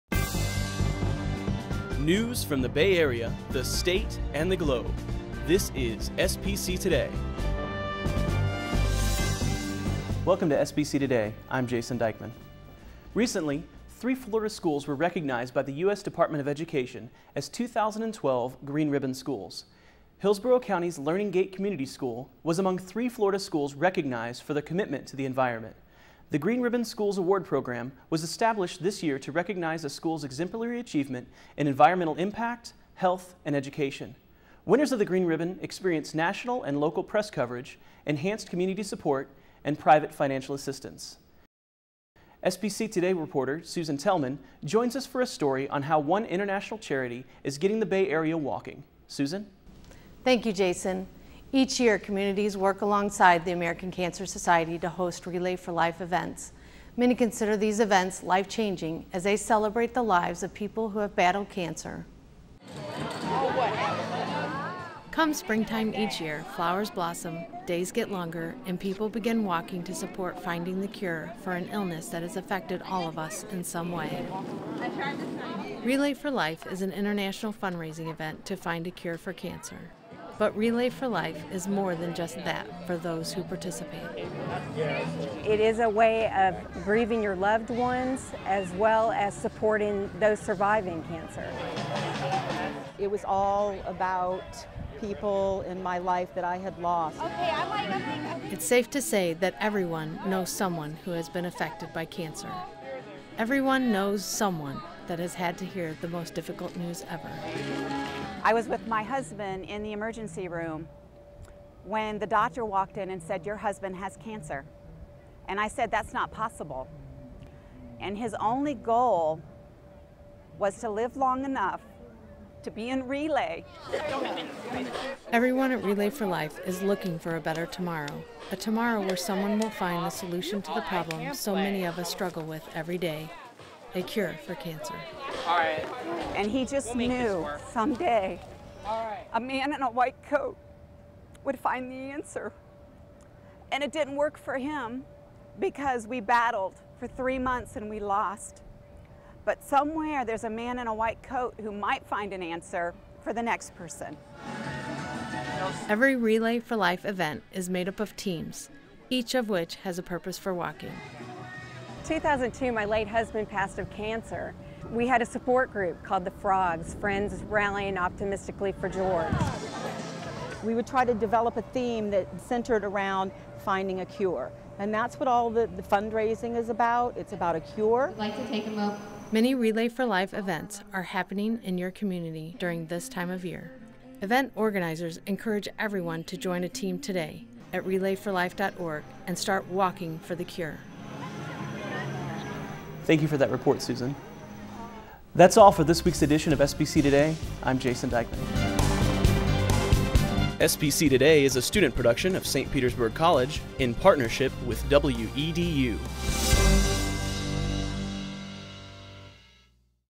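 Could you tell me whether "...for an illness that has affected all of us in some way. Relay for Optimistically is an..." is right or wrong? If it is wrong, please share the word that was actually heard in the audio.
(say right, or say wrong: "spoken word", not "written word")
wrong: "Life", not "Optimistically".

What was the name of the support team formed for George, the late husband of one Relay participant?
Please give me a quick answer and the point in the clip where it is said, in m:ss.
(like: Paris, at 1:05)
the Frogs, at 2:46.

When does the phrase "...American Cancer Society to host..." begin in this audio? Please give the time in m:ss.
0:53.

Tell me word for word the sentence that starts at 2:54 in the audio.
And that's what all the, the fundraising is about.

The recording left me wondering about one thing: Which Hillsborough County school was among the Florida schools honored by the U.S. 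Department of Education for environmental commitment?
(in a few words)
Learning Gate Community School.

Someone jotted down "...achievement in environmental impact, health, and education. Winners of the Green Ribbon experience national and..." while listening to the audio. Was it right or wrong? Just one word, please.
right.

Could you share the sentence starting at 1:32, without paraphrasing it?
It was all about people in my life that I had lost.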